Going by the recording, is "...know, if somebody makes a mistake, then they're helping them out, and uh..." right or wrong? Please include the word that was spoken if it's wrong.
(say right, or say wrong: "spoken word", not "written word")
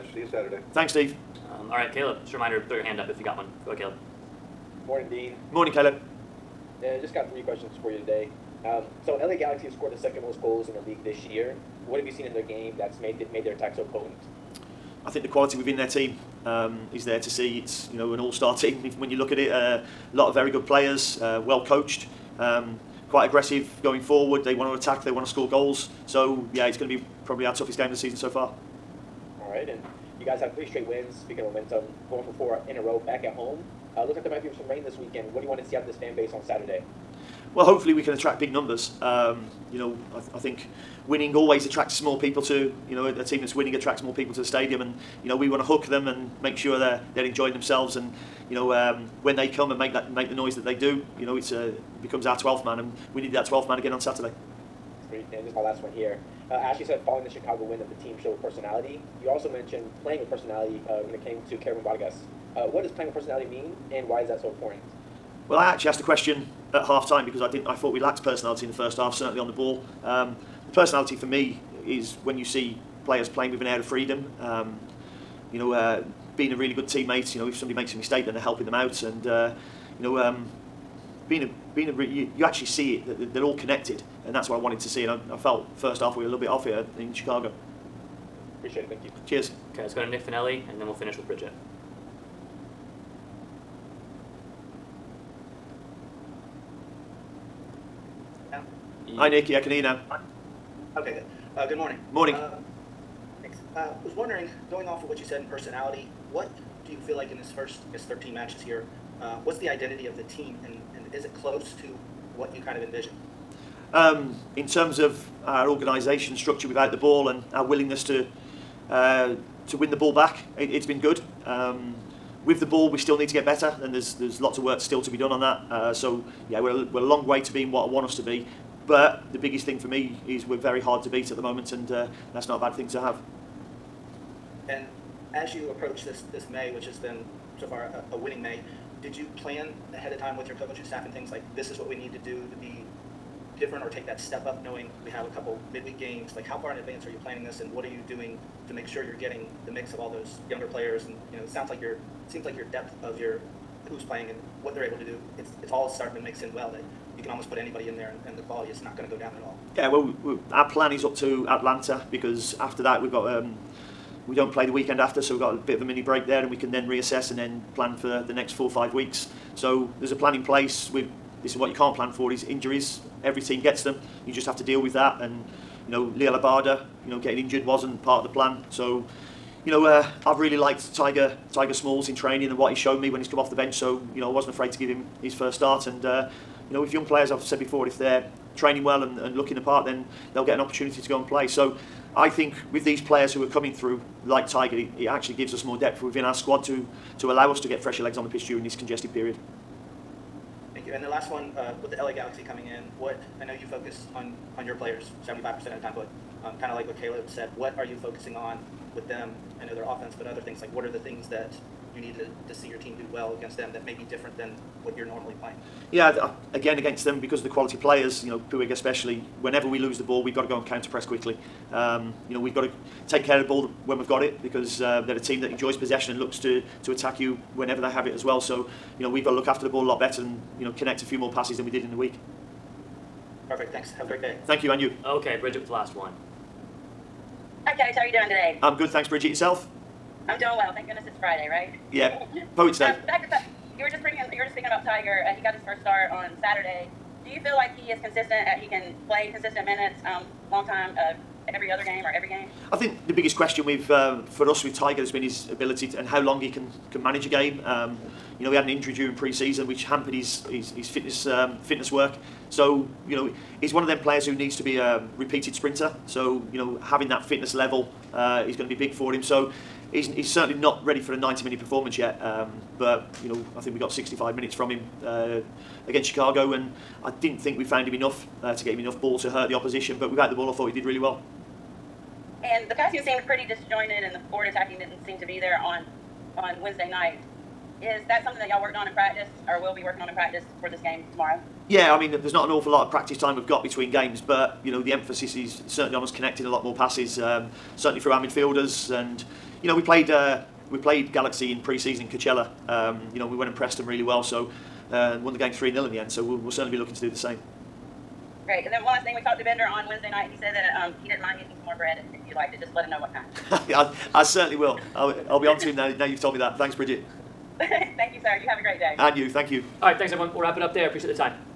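right.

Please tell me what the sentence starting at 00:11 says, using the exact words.
What have you seen in their game that's made that made their attack so potent?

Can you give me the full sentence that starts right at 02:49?
So there's a plan in place.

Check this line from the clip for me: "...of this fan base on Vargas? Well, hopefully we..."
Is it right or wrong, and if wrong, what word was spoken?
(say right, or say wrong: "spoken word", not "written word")
wrong: "Saturday", not "Vargas".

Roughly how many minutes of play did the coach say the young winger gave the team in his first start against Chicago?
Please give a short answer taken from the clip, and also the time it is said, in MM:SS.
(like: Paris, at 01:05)
65, at 04:33.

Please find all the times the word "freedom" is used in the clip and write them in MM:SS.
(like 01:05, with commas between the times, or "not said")
01:13.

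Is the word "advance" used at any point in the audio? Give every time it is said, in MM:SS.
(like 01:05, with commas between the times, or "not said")
02:26.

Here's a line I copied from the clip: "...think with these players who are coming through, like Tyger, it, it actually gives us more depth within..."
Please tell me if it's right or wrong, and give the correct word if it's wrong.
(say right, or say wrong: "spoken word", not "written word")
right.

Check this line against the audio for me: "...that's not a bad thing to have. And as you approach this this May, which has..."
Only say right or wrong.
right.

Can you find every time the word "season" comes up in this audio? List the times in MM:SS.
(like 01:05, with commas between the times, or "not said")
00:27, 04:19, 05:01.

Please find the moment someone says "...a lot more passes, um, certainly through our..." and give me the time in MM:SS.
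04:56.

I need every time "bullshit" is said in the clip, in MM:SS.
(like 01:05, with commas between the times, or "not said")
not said.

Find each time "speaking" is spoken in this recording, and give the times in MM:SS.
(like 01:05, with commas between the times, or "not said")
00:31, 04:04.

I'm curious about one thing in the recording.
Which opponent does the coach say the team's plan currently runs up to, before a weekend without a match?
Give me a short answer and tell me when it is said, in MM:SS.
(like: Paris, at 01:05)
Atlanta, at 02:41.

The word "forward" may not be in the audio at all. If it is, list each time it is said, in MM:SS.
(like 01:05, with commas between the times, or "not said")
00:24, 04:44.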